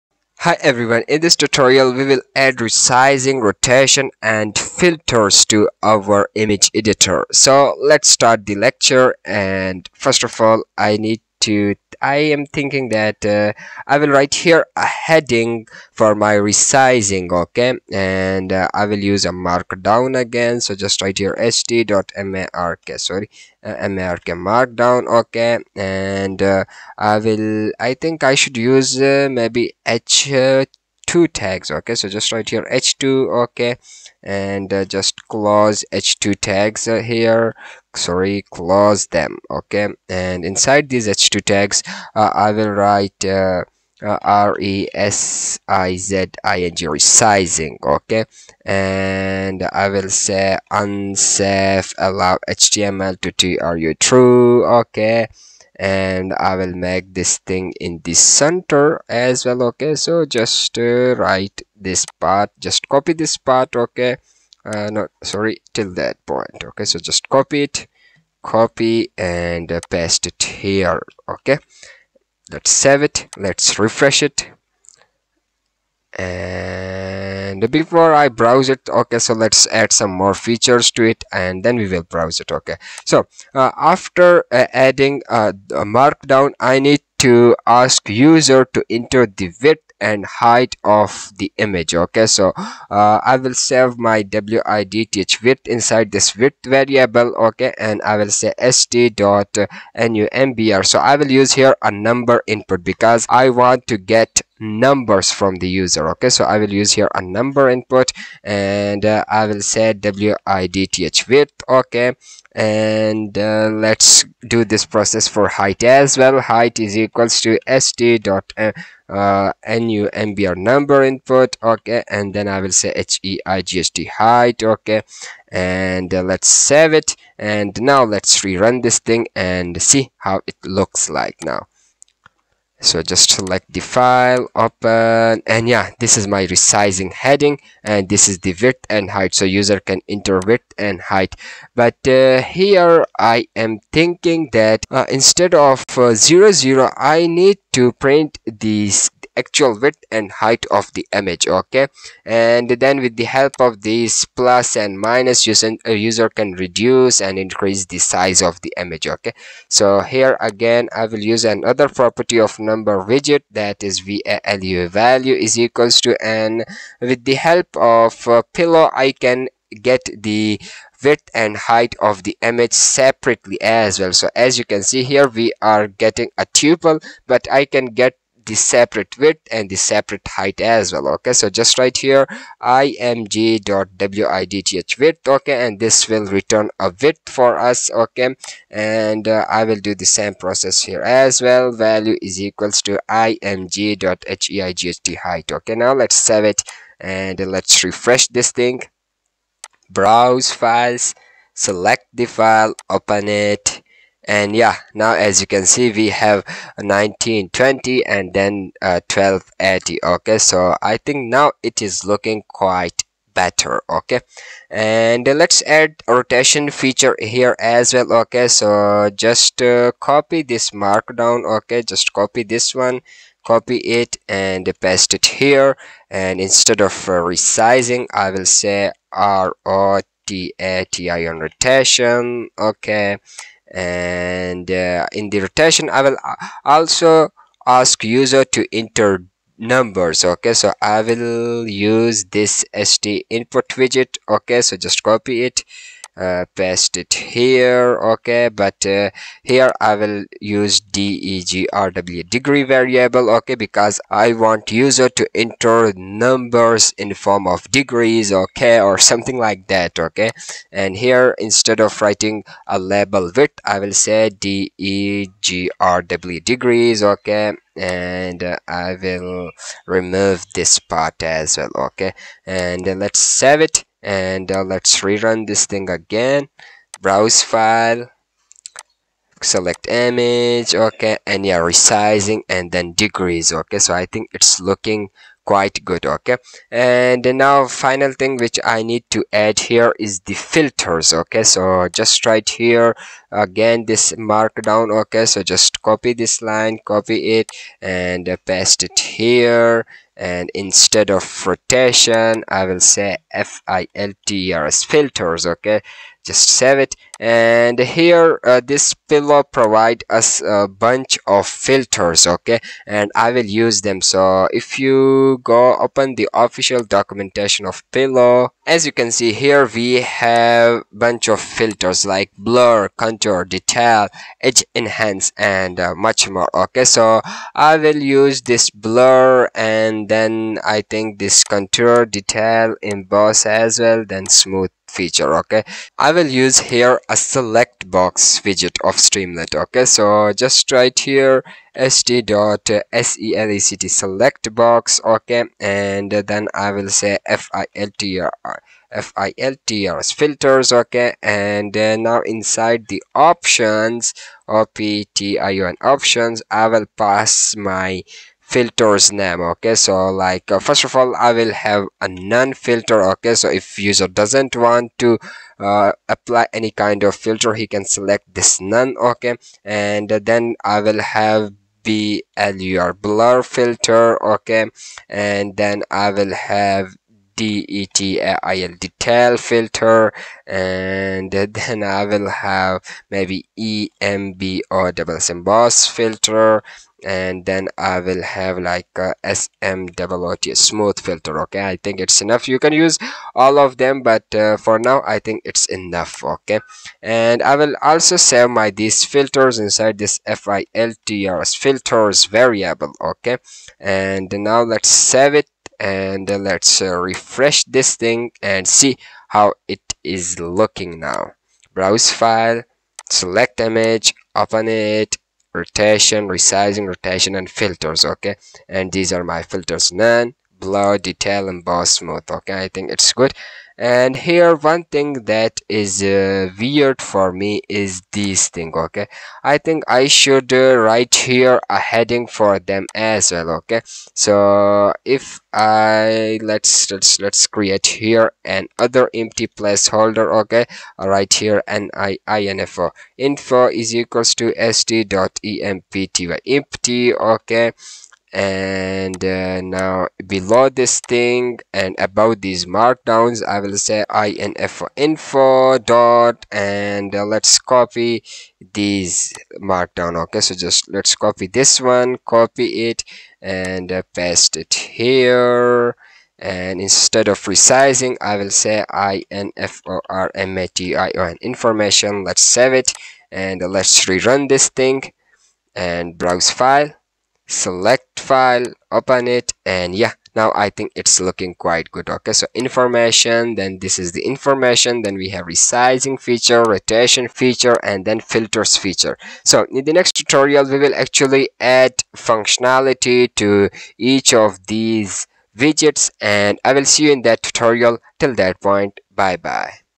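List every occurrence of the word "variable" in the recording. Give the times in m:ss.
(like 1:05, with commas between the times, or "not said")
1:36, 4:12, 6:42.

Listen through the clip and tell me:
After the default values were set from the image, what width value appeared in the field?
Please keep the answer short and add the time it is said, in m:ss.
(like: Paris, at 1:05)
1920, at 3:26.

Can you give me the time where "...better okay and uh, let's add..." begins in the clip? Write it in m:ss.
3:33.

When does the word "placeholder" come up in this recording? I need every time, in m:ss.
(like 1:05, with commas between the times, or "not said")
7:19.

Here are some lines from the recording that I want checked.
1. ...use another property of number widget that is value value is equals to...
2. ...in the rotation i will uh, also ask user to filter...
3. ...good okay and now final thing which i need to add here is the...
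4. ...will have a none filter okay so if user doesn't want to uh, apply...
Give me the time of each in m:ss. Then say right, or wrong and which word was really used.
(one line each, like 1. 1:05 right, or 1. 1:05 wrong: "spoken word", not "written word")
1. 2:41 right
2. 3:55 wrong: "enter", not "filter"
3. 4:45 right
4. 6:01 right.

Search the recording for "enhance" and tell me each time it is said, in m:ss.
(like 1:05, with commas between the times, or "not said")
5:24.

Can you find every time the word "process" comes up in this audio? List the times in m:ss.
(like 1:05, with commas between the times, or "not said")
1:54, 3:10.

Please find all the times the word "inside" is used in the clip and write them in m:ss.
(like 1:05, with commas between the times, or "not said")
0:40, 1:35, 5:52, 6:39.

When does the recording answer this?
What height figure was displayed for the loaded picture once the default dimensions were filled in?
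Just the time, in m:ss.
3:29.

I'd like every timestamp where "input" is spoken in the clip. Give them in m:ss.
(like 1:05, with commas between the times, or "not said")
1:42, 1:47, 2:01, 4:03.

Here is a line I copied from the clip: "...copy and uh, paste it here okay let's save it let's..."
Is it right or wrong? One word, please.
right.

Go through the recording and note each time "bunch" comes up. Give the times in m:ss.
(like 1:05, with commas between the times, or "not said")
5:10, 5:20.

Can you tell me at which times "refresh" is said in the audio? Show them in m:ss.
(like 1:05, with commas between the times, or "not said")
1:13, 3:17, 6:46.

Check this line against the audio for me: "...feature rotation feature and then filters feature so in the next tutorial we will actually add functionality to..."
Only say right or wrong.
right.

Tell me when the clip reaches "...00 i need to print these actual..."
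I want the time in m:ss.
2:26.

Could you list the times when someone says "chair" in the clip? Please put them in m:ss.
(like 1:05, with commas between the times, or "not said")
not said.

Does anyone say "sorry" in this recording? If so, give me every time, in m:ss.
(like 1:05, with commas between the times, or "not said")
0:22, 0:37, 1:05.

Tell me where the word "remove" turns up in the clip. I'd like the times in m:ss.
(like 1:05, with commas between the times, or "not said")
4:29.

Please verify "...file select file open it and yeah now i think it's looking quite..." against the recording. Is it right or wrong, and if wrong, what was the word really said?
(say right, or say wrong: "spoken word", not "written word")
right.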